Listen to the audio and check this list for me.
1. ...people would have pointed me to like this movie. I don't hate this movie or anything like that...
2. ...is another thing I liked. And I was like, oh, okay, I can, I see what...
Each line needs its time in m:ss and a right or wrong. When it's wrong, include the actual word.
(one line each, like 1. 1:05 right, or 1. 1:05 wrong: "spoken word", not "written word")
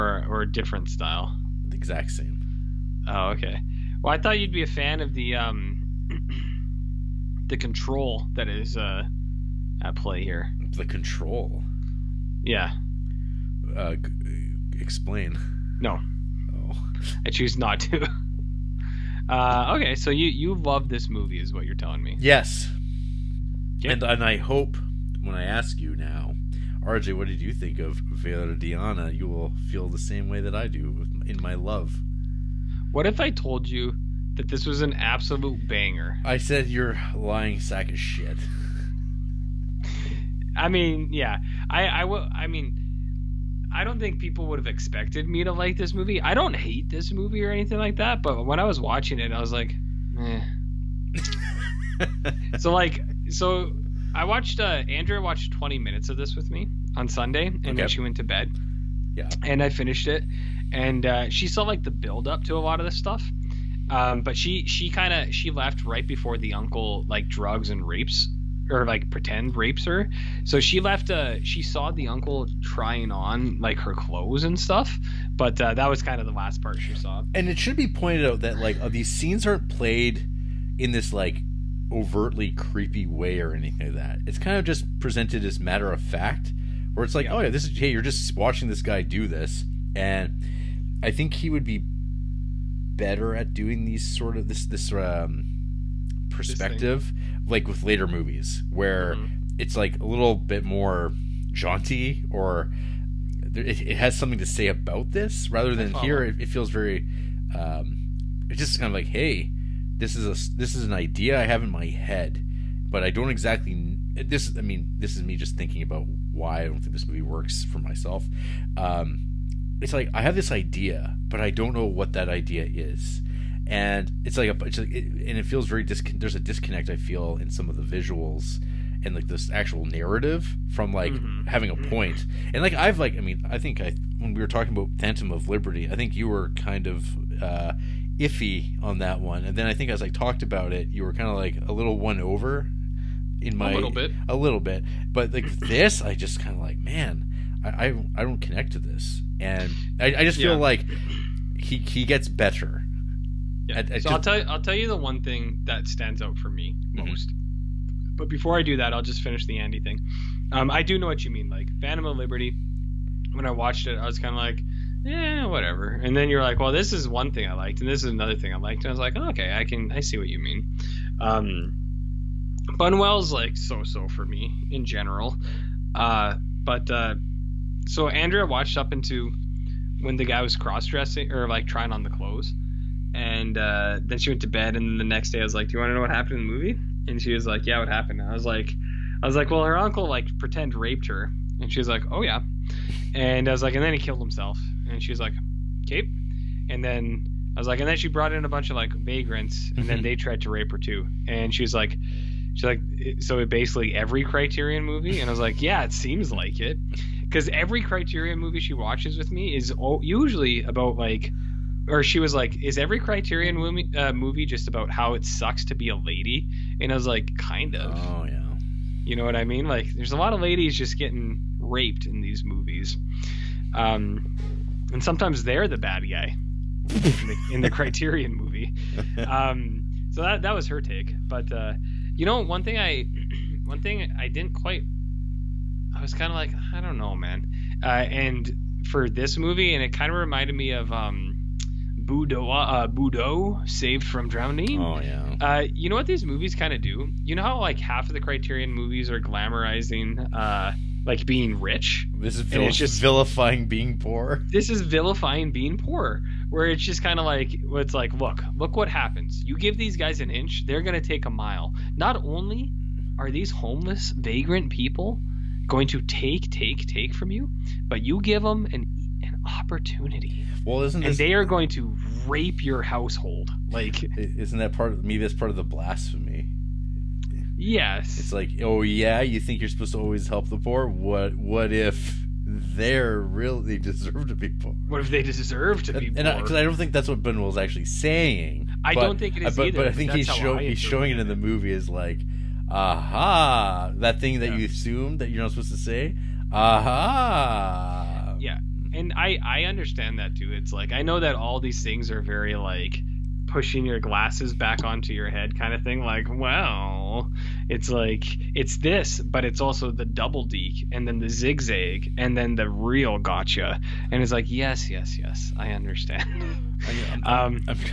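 1. 0:44 wrong: "expected", not "pointed"
2. 2:48 right.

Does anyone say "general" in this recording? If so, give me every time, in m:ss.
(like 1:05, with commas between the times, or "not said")
2:54.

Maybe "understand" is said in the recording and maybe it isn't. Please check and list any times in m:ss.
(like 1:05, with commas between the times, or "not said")
4:59, 5:15.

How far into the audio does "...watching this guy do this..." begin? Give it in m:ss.
1:28.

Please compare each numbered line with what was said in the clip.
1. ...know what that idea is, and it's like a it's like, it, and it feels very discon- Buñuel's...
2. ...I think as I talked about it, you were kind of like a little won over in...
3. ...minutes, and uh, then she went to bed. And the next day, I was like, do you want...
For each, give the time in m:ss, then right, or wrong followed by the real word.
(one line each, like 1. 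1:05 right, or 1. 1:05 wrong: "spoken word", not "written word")
1. 2:01 wrong: "There", not "Buñuel"
2. 2:19 right
3. 3:02 wrong: "clothes", not "minutes".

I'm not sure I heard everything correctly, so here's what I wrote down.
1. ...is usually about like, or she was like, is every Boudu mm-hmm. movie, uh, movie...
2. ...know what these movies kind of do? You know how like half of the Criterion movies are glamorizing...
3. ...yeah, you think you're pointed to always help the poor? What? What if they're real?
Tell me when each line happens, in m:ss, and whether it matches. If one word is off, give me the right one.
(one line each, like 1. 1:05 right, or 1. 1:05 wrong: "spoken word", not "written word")
1. 3:29 wrong: "Criterion", not "Boudu"
2. 4:05 right
3. 4:38 wrong: "supposed", not "pointed".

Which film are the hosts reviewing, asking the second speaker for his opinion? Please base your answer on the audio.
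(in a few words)
Viridiana.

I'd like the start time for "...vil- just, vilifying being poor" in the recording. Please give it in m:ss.
4:12.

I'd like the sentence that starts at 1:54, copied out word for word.
I mean, this is me just thinking about why I don't think this movie works for myself.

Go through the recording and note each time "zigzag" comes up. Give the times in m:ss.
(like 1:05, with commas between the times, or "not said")
5:11.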